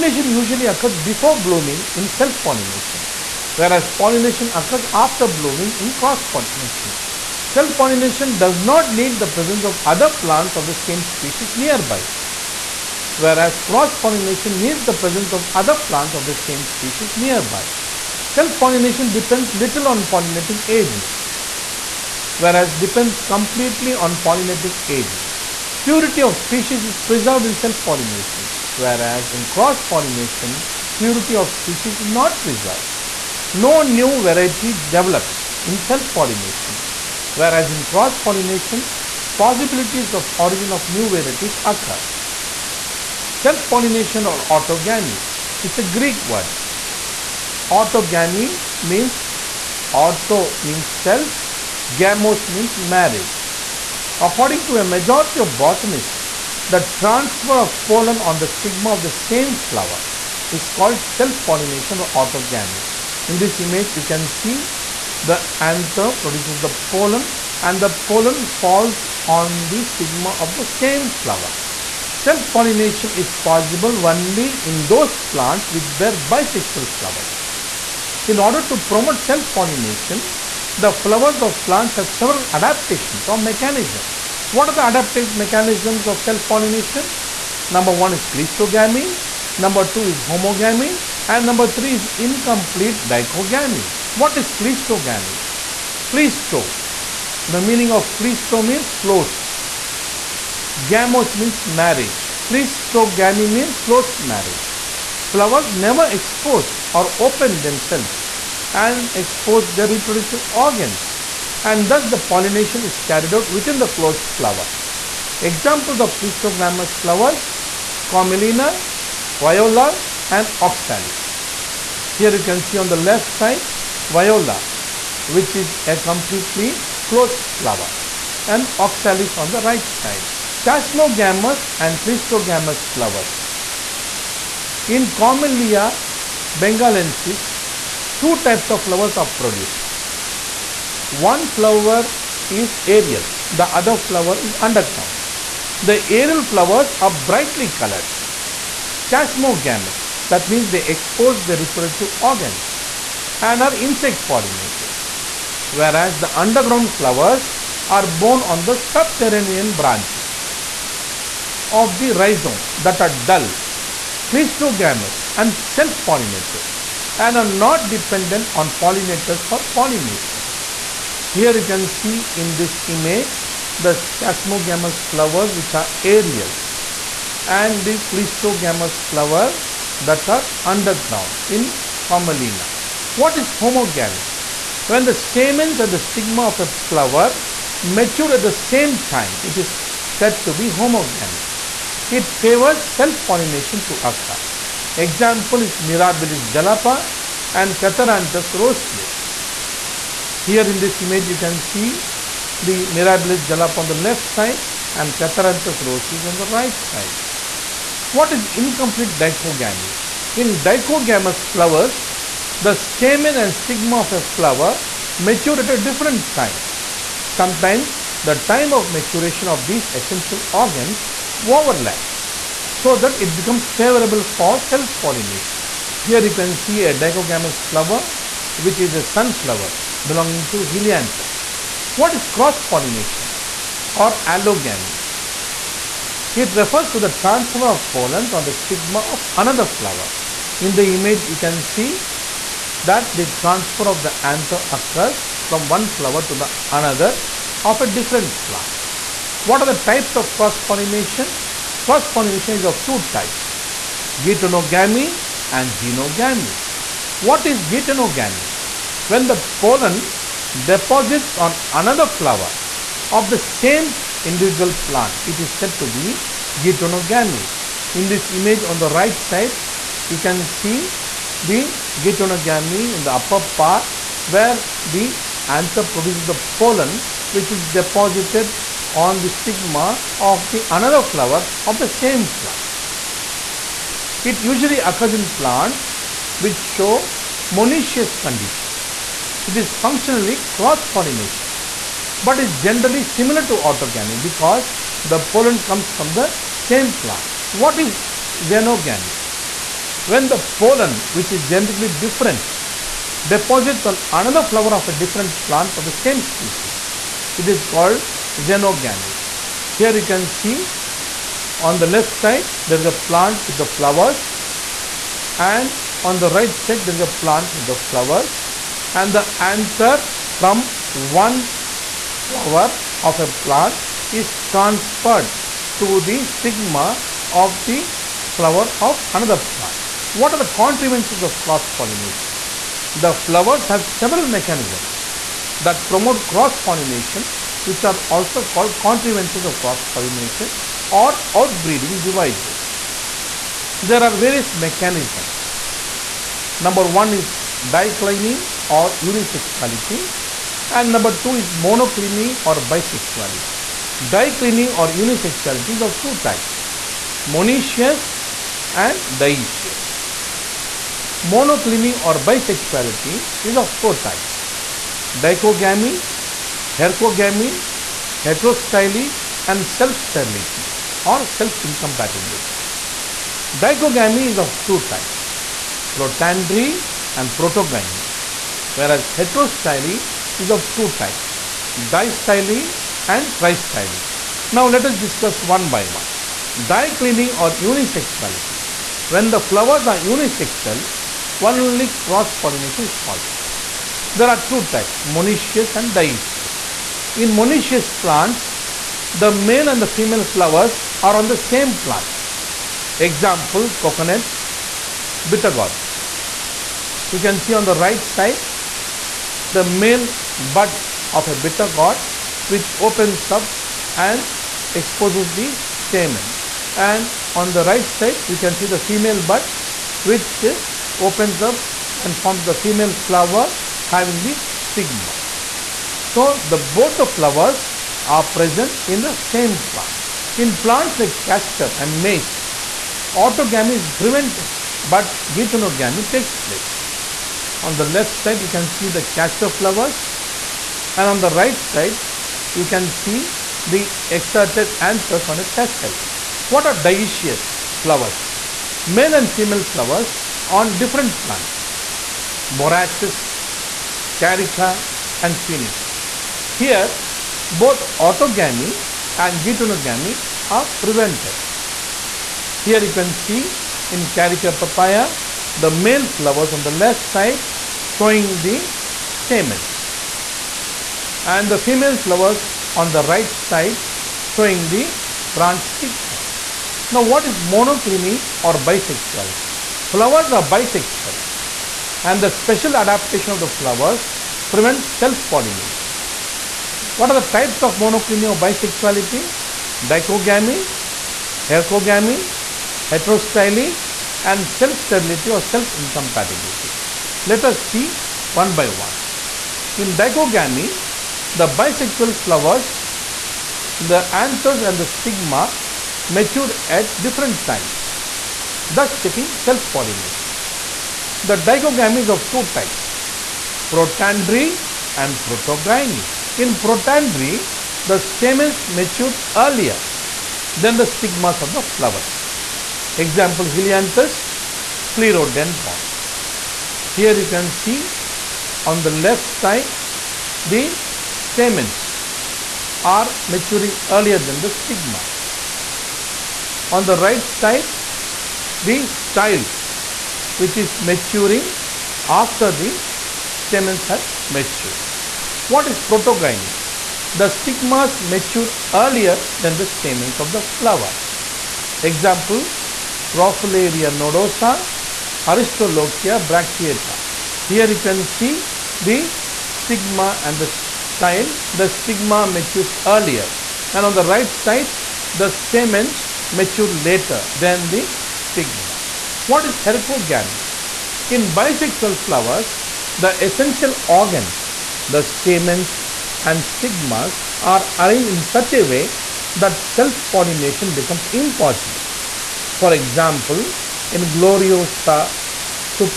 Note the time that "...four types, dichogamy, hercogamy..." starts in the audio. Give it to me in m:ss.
6:03.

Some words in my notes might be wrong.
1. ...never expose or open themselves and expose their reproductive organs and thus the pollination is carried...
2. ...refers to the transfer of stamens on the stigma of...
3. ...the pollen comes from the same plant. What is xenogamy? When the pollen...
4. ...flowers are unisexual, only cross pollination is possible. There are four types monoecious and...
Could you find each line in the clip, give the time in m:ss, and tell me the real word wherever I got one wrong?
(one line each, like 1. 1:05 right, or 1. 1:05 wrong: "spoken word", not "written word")
1. 1:45 right
2. 3:56 wrong: "pollens", not "stamens"
3. 4:55 right
4. 6:29 wrong: "two", not "four".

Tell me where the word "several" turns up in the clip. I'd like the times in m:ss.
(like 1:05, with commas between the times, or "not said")
1:22, 5:34.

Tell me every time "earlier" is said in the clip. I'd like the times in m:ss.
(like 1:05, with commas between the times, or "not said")
8:39, 8:53, 9:08, 9:22.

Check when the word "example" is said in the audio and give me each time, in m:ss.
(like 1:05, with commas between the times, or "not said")
1:55, 3:14, 6:42, 8:42, 9:11, 9:42.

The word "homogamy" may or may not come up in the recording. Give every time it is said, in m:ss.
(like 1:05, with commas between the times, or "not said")
1:30, 3:03, 3:10.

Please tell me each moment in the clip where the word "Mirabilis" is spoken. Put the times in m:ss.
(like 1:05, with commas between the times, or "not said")
3:15, 3:22.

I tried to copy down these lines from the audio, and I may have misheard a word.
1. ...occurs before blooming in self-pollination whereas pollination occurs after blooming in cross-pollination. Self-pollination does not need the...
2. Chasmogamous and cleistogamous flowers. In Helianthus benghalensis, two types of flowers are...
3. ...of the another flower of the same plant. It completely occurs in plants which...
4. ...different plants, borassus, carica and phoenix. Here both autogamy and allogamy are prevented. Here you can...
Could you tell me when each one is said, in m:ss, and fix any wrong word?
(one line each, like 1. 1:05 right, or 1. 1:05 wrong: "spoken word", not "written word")
1. 0:00 right
2. 2:10 wrong: "Commelina", not "Helianthus"
3. 4:40 wrong: "usually", not "completely"
4. 7:30 wrong: "geitonogamy", not "allogamy".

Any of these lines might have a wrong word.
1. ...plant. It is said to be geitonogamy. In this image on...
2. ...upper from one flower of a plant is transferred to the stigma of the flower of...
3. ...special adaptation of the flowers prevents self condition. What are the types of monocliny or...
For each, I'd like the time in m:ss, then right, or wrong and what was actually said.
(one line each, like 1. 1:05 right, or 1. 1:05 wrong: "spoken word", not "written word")
1. 4:24 right
2. 5:19 wrong: "anther", not "upper"
3. 8:02 wrong: "pollination", not "condition".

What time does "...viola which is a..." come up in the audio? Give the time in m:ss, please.
2:04.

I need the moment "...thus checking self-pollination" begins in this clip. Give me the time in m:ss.
8:28.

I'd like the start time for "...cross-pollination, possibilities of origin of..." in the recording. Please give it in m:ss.
0:37.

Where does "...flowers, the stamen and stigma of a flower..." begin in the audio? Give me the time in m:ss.
3:31.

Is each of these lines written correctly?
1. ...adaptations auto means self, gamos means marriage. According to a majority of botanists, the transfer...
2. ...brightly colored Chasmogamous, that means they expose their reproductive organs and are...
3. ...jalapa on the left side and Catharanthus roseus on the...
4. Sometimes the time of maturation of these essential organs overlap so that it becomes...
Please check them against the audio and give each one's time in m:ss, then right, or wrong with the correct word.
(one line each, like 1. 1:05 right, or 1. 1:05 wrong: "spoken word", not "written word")
1. 0:48 wrong: "means", not "adaptations"
2. 2:27 right
3. 3:23 right
4. 3:37 right.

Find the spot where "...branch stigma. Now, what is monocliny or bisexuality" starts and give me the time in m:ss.
7:55.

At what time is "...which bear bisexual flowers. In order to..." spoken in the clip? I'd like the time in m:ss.
1:15.